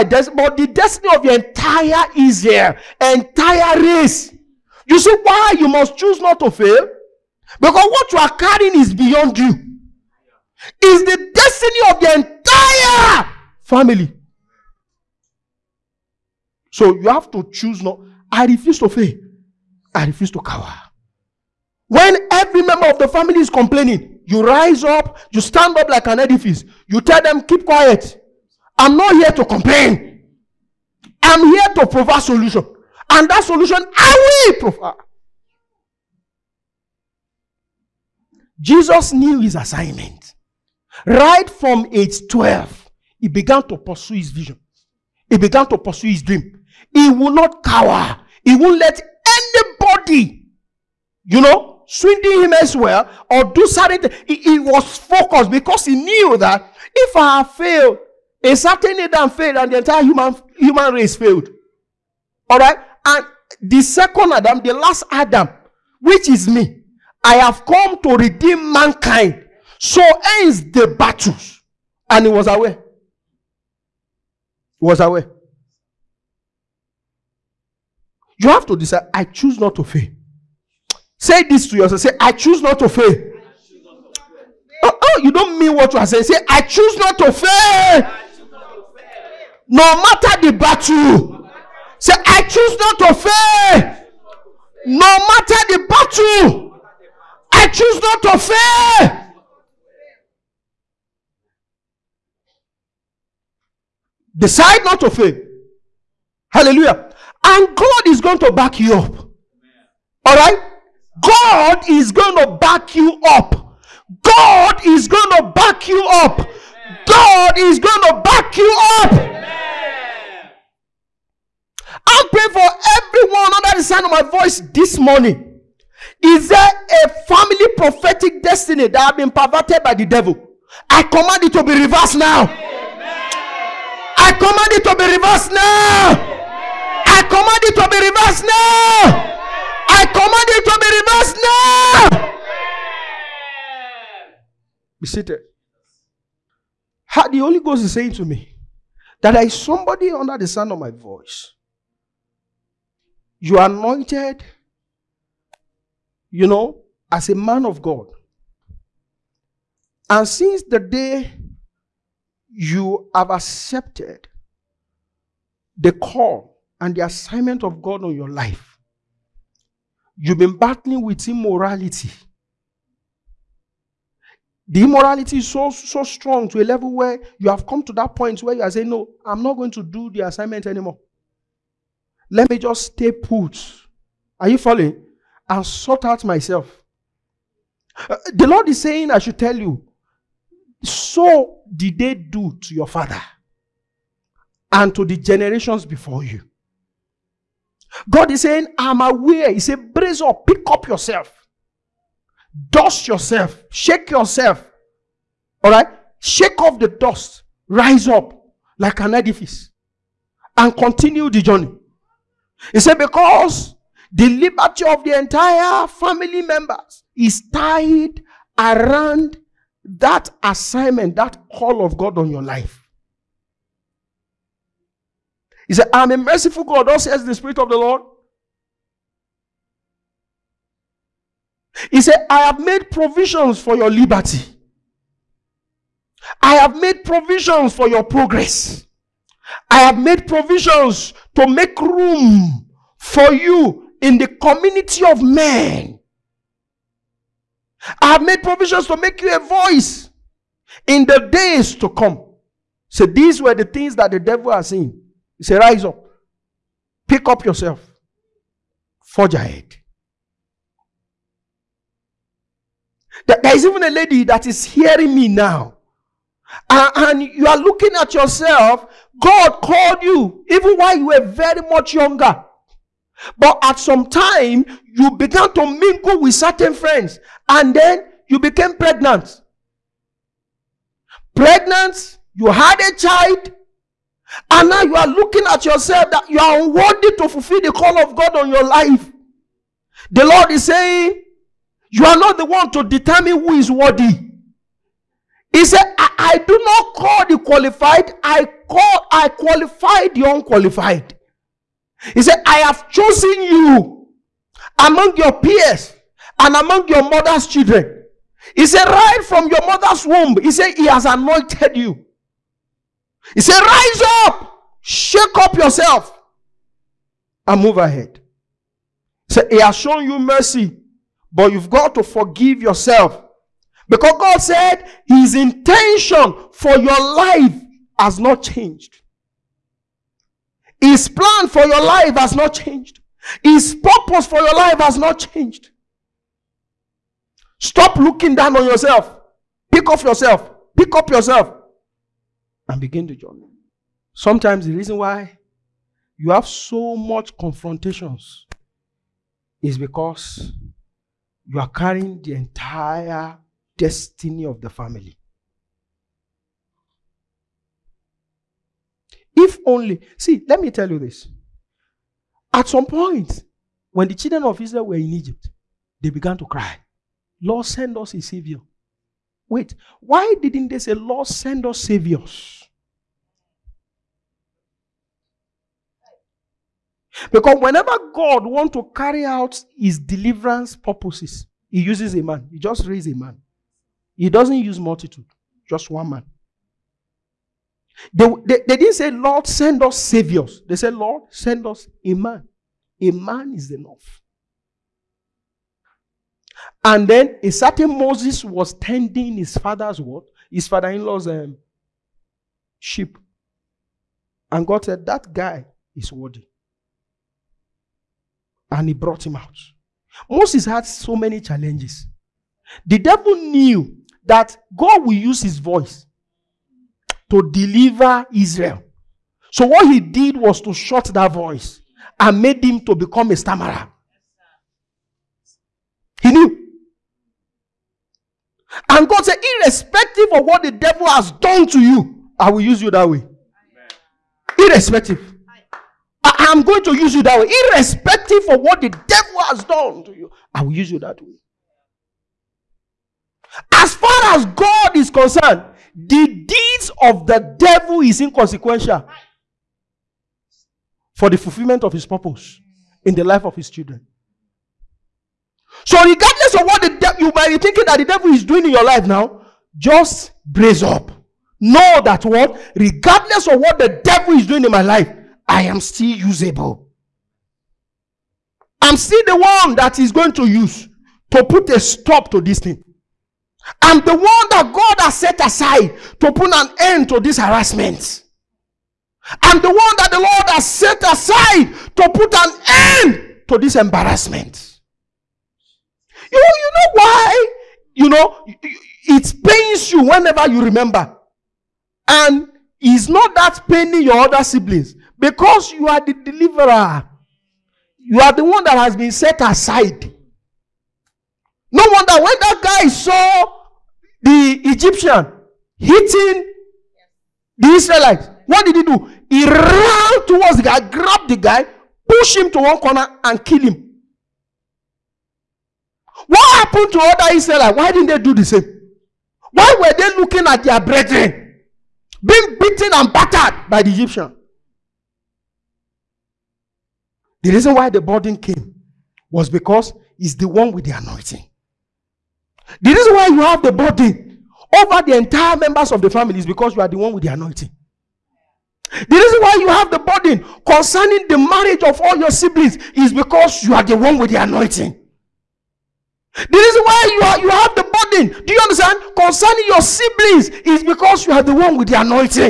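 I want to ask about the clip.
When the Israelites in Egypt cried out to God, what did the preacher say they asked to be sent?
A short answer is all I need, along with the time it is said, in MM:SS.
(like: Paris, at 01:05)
A savior, at 06:08.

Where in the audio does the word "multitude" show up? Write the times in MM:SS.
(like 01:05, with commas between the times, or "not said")
06:24.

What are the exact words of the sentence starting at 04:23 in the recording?
There is even a lady that is hearing me now.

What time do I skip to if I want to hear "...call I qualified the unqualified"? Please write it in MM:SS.
04:58.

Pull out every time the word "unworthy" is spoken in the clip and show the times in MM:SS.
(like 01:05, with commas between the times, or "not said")
04:46.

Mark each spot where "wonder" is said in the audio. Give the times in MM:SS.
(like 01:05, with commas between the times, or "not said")
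08:21.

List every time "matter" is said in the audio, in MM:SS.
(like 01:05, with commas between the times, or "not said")
01:30, 01:35.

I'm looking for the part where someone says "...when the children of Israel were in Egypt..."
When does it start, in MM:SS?
06:03.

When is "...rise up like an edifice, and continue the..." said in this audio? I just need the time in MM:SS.
03:27.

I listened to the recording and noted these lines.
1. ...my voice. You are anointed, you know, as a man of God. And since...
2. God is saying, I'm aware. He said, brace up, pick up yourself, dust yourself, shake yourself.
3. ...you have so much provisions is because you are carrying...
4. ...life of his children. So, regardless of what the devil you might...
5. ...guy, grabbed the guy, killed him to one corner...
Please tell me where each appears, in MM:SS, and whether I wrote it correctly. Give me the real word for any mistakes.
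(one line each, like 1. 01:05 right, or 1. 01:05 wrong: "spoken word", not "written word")
1. 02:30 right
2. 03:18 right
3. 05:46 wrong: "confrontations", not "provisions"
4. 07:33 right
5. 08:30 wrong: "pushed", not "killed".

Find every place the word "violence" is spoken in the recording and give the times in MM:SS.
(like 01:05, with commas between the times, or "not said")
not said.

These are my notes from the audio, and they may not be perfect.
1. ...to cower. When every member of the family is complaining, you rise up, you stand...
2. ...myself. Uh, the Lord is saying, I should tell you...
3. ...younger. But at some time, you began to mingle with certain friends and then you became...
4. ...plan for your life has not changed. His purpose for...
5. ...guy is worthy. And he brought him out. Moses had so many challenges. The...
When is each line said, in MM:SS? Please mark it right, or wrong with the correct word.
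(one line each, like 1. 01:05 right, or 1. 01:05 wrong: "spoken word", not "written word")
1. 00:20 right
2. 03:06 right
3. 04:31 right
4. 05:31 right
5. 06:45 right.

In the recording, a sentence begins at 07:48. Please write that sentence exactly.
I'm still the one that is going to use to put a stop to this thing.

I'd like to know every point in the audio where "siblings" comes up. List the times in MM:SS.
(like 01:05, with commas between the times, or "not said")
08:14, 09:02, 09:09.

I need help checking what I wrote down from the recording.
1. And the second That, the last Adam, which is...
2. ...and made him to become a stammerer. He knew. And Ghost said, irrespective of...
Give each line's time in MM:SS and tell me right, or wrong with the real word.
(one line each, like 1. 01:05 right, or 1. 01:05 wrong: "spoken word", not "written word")
1. 01:03 wrong: "Adam", not "That"
2. 07:02 wrong: "God", not "Ghost".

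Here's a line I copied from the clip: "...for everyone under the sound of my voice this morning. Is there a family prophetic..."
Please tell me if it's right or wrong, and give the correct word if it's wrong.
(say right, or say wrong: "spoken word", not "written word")
right.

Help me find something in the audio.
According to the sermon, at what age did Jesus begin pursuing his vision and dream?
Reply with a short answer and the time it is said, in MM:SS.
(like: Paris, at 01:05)
12, at 00:41.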